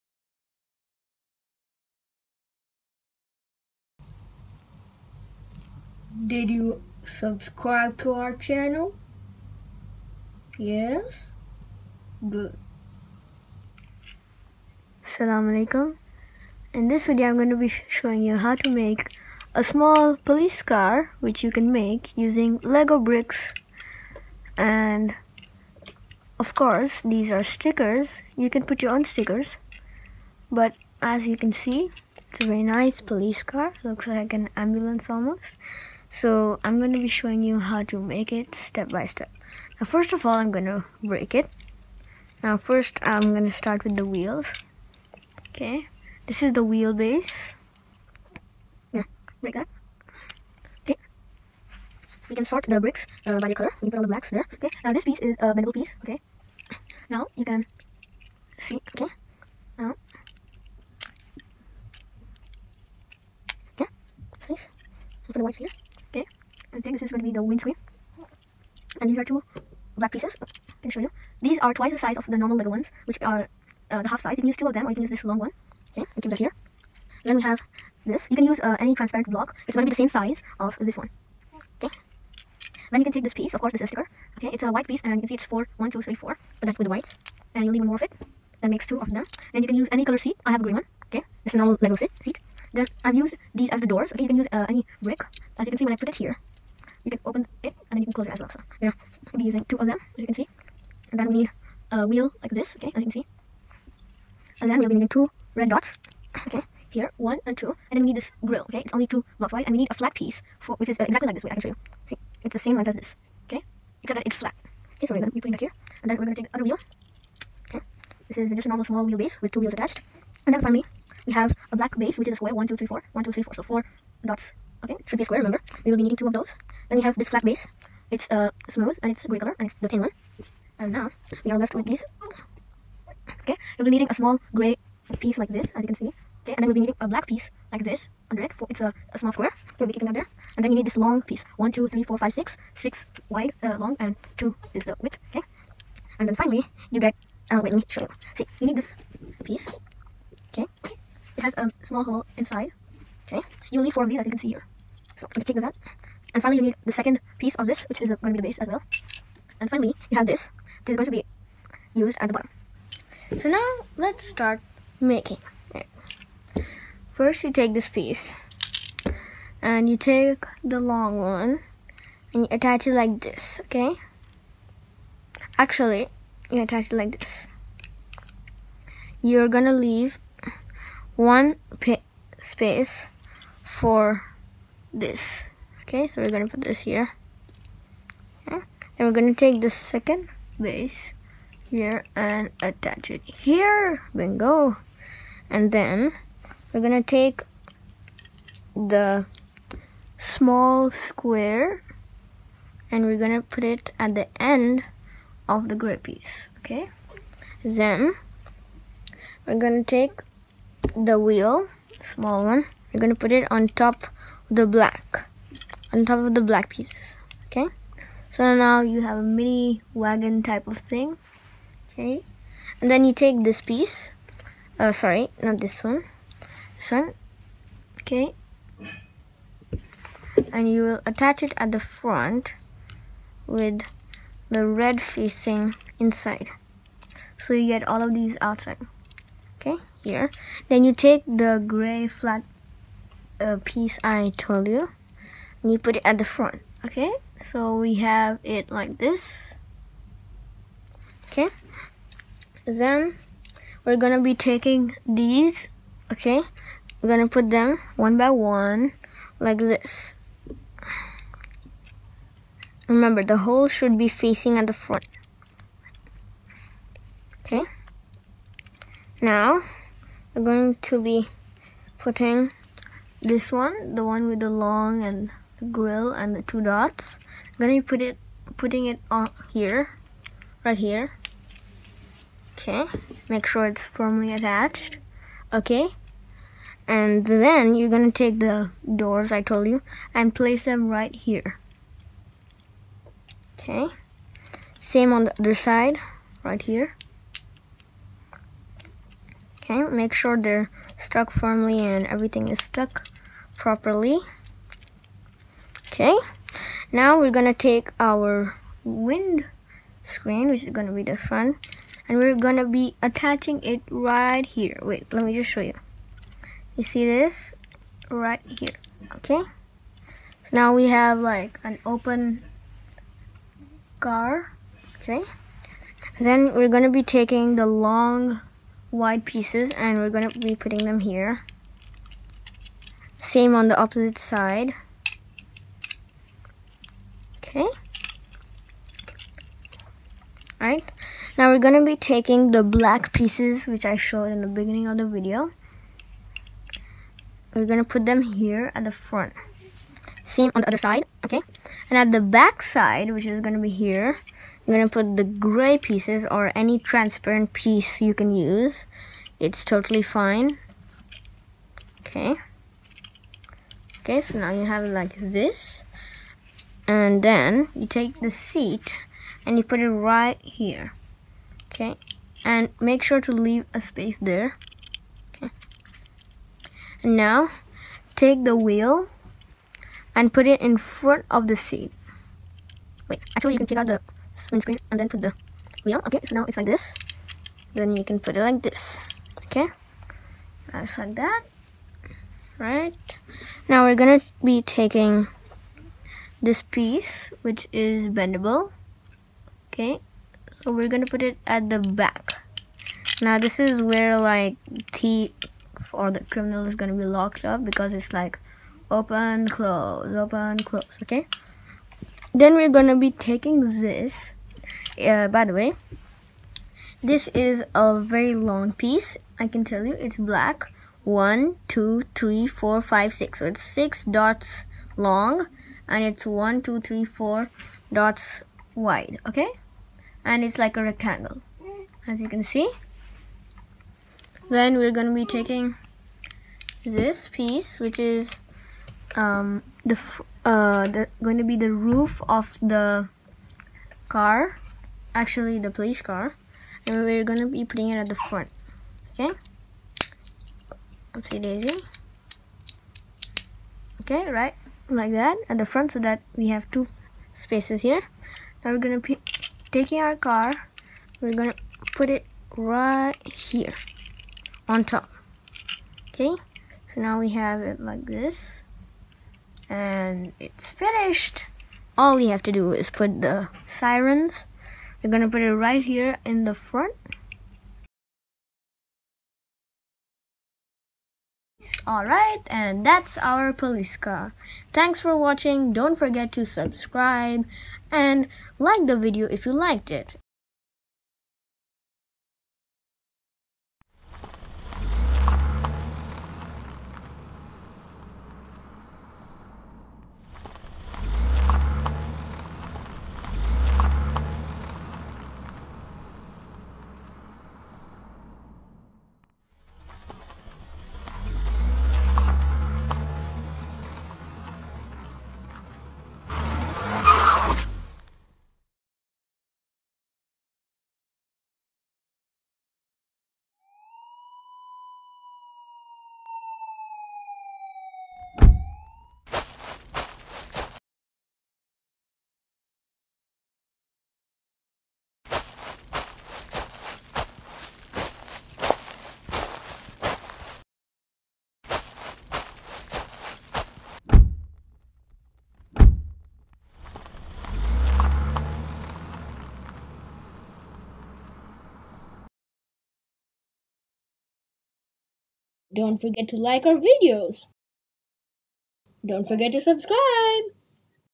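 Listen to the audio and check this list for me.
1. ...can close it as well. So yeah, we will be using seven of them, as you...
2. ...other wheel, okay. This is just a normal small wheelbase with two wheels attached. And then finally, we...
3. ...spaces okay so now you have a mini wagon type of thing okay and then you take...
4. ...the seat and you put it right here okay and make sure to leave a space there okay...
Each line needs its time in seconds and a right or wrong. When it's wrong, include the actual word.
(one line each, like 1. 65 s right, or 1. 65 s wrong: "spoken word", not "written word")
1. 98 s wrong: "two", not "seven"
2. 116 s right
3. 216 s wrong: "pieces", not "spaces"
4. 368 s right.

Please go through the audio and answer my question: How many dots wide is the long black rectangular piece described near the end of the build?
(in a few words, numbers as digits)
4.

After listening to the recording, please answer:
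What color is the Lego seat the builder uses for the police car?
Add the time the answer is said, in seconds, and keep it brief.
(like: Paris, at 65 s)
Green, at 90 s.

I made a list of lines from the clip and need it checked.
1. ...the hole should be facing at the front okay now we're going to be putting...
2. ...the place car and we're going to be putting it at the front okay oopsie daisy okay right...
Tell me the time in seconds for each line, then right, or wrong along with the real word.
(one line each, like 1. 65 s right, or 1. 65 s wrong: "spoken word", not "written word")
1. 263 s right
2. 445 s wrong: "police", not "place".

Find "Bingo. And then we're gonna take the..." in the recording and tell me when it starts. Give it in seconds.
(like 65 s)
194 s.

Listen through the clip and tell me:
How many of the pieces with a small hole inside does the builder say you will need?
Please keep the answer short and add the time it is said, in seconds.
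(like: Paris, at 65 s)
4, at 153 s.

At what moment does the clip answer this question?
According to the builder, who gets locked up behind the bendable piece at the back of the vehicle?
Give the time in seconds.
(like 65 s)
406 s.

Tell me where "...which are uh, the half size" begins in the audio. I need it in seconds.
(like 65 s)
73 s.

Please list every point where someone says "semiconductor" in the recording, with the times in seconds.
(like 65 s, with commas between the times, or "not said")
not said.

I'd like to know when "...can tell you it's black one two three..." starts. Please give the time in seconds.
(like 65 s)
419 s.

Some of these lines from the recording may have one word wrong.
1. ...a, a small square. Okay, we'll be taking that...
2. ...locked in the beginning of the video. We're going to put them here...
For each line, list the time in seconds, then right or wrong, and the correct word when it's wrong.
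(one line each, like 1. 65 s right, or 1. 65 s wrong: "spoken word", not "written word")
1. 138 s wrong: "keeping", not "taking"
2. 343 s wrong: "showed", not "locked".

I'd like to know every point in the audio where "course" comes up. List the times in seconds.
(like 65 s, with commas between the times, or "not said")
26 s, 83 s.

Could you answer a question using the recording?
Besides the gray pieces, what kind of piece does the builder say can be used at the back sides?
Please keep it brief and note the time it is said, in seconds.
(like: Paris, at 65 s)
Any transparent piece, at 356 s.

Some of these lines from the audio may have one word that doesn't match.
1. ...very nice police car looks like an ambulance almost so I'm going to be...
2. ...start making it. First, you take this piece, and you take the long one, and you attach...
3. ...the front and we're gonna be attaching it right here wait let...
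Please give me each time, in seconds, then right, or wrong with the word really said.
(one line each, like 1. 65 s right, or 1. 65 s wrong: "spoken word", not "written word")
1. 32 s right
2. 164 s right
3. 311 s right.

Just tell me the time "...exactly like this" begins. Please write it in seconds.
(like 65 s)
111 s.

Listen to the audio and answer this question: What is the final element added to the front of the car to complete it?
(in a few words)
The sirens.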